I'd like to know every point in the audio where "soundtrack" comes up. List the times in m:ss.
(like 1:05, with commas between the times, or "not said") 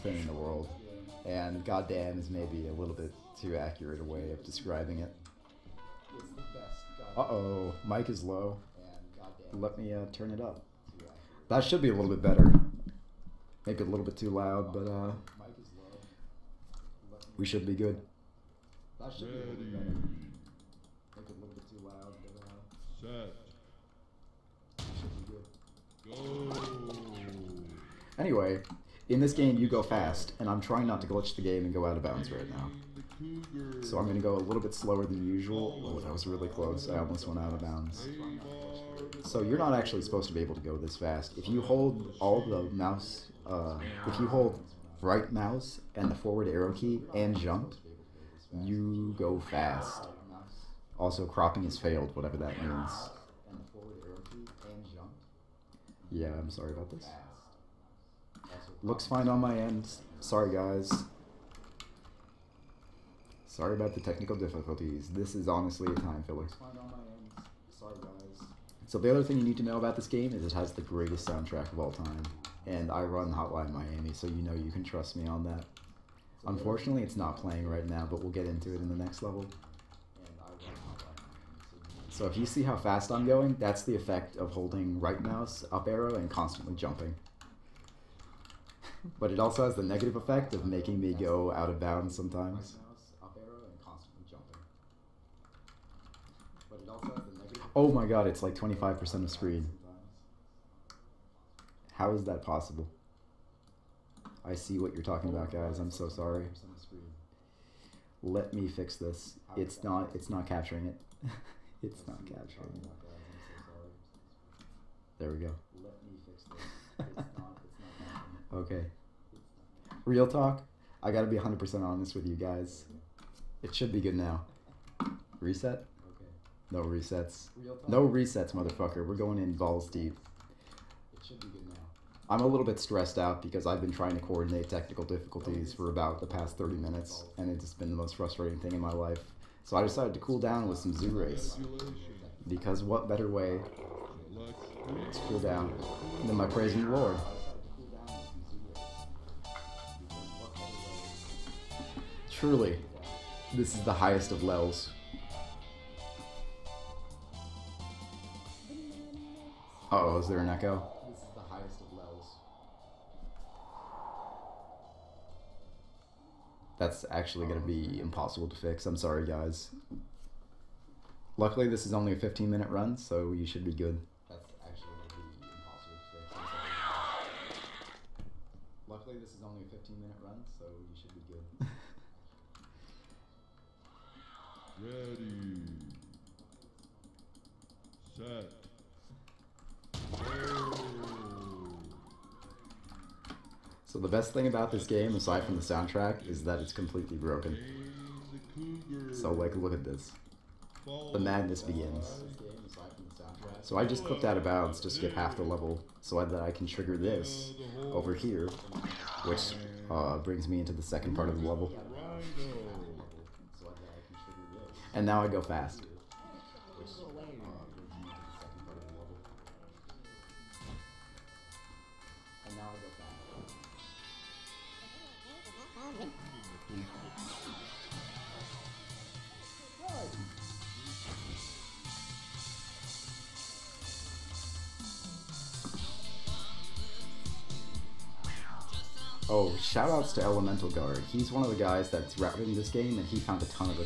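1:11, 3:15.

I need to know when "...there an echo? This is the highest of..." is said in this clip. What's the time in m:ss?
2:40.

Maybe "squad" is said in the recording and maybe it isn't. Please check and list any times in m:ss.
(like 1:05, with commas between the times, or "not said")
not said.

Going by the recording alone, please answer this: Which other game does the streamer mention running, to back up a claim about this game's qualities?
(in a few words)
Hotline Miami.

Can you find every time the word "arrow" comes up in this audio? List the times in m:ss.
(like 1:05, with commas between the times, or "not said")
0:46, 1:25.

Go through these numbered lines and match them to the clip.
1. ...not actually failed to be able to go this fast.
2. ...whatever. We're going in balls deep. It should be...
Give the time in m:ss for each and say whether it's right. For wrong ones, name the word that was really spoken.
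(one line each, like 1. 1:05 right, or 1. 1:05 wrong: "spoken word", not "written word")
1. 0:39 wrong: "supposed", not "failed"
2. 2:08 wrong: "motherfucker", not "whatever".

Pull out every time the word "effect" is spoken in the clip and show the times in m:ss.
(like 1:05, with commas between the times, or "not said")
1:23, 1:30.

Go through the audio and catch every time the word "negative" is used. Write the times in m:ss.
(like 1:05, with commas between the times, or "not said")
1:29.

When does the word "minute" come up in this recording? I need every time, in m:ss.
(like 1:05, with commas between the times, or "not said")
2:16, 2:52, 3:00.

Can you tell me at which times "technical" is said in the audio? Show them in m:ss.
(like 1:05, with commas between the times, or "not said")
1:04, 2:14.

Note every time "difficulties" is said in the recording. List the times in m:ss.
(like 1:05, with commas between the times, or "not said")
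1:04, 2:15.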